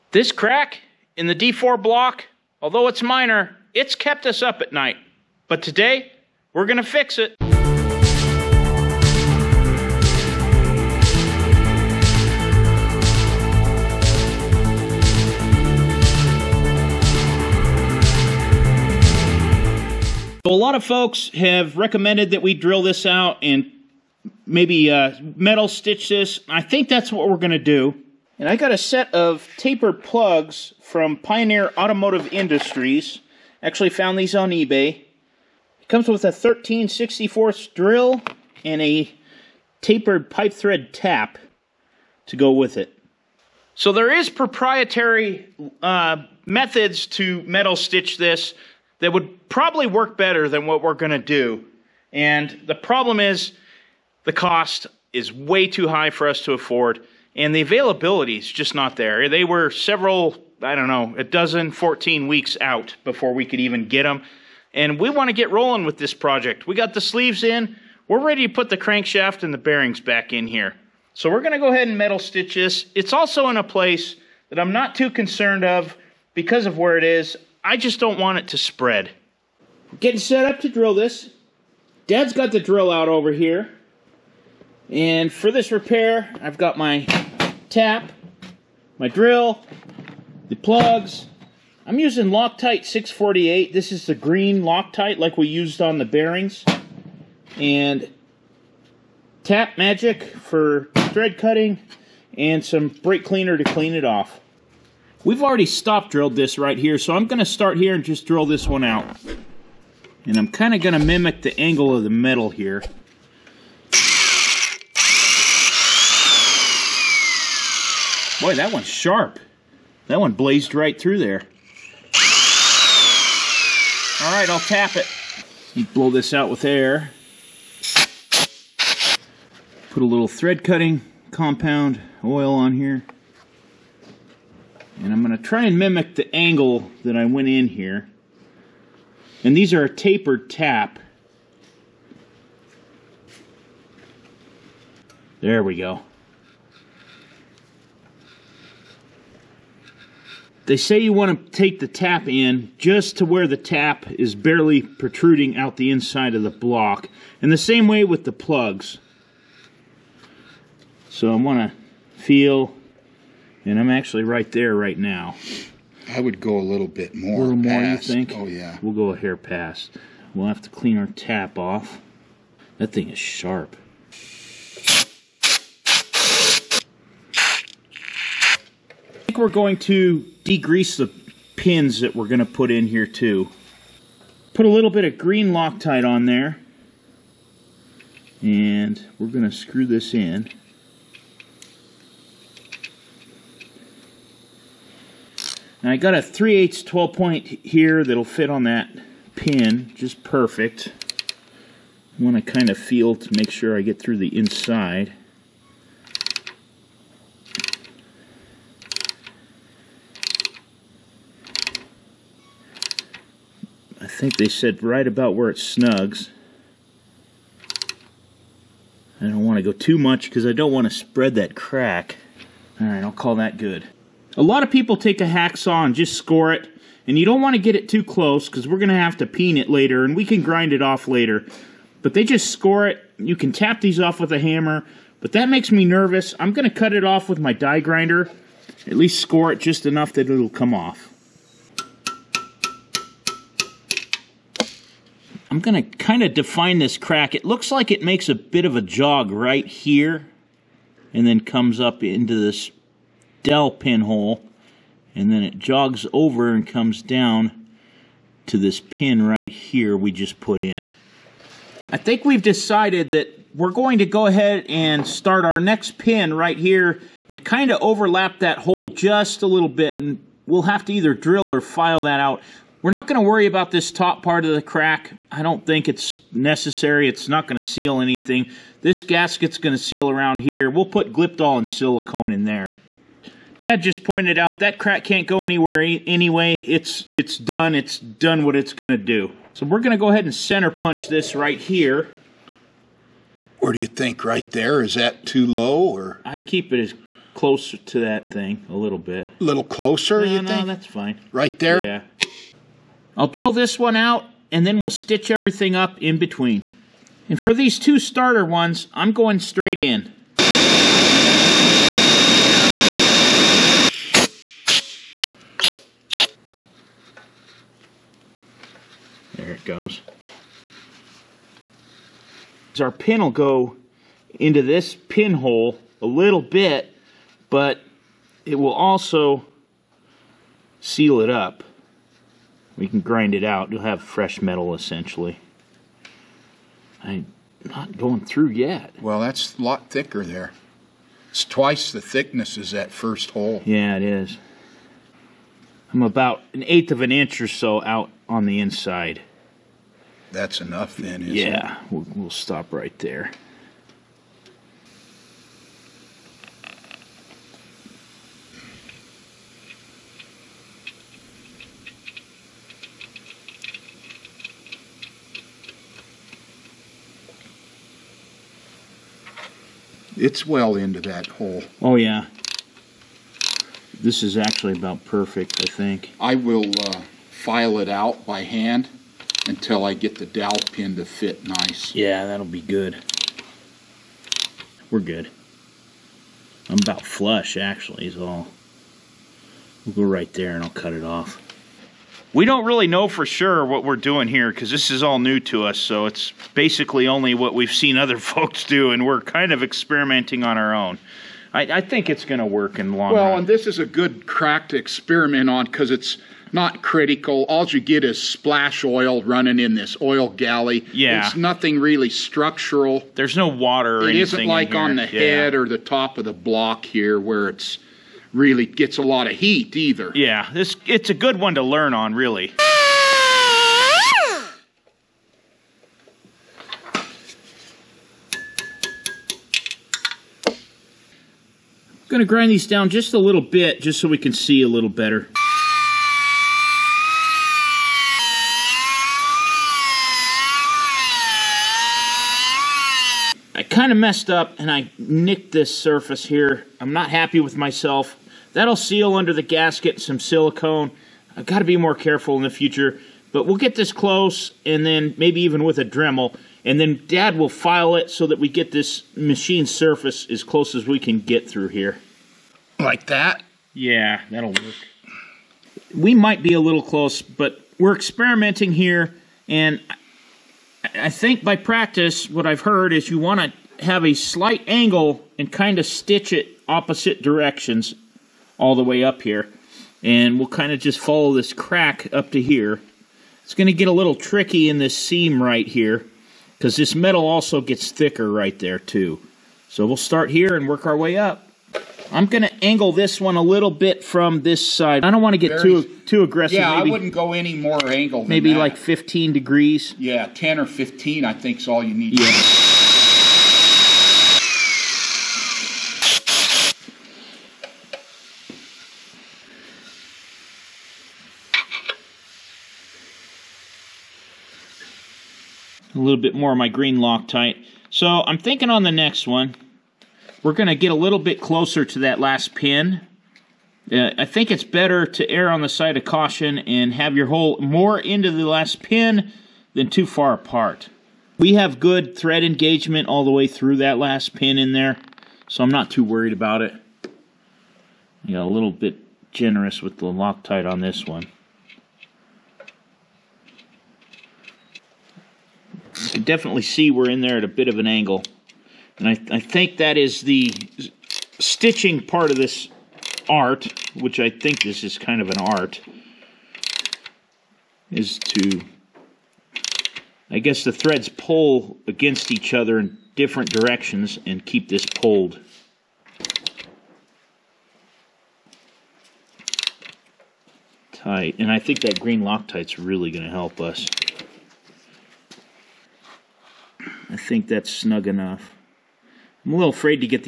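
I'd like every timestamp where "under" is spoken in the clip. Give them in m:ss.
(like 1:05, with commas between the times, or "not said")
7:29.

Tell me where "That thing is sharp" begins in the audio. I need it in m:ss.
2:52.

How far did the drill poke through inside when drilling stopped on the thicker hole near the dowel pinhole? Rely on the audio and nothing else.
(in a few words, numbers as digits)
an eighth of an inch.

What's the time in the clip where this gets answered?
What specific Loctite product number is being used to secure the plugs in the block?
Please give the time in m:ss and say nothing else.
1:32.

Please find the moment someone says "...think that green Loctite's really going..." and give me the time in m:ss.
9:31.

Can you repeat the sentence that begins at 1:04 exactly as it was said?
And we want to get rolling with this project.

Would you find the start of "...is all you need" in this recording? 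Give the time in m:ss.
8:21.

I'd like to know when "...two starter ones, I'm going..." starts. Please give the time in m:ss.
5:07.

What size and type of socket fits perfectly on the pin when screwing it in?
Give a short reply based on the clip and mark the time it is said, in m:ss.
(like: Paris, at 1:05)
3/8 12 point, at 3:16.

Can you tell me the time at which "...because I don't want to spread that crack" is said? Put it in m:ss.
3:40.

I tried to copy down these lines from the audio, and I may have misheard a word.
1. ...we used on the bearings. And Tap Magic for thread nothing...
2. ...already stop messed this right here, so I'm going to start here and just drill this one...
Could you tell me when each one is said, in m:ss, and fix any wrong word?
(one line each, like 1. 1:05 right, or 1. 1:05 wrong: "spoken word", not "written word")
1. 1:35 wrong: "cutting", not "nothing"
2. 1:45 wrong: "drilled", not "messed".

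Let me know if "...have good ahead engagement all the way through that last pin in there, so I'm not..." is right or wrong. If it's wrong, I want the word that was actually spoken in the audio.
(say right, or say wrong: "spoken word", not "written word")
wrong: "thread", not "ahead".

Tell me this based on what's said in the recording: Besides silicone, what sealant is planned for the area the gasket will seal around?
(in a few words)
Glyptal.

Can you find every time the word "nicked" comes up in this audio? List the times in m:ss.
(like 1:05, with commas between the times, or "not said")
7:24.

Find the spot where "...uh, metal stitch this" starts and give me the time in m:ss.
0:24.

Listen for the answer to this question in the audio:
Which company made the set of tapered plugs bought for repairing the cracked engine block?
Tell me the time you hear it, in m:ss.
0:31.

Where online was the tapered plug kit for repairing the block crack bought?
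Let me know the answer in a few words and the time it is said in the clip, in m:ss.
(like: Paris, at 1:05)
eBay, at 0:34.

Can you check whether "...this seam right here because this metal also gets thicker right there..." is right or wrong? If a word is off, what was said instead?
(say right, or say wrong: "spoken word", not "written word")
right.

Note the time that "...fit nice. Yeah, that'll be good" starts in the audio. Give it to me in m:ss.
6:21.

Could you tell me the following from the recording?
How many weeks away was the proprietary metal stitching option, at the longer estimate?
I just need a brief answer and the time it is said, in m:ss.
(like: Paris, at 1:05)
14, at 1:01.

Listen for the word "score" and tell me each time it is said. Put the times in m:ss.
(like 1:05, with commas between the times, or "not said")
3:46, 3:52, 3:59.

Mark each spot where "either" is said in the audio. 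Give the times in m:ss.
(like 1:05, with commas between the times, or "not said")
4:30, 6:59.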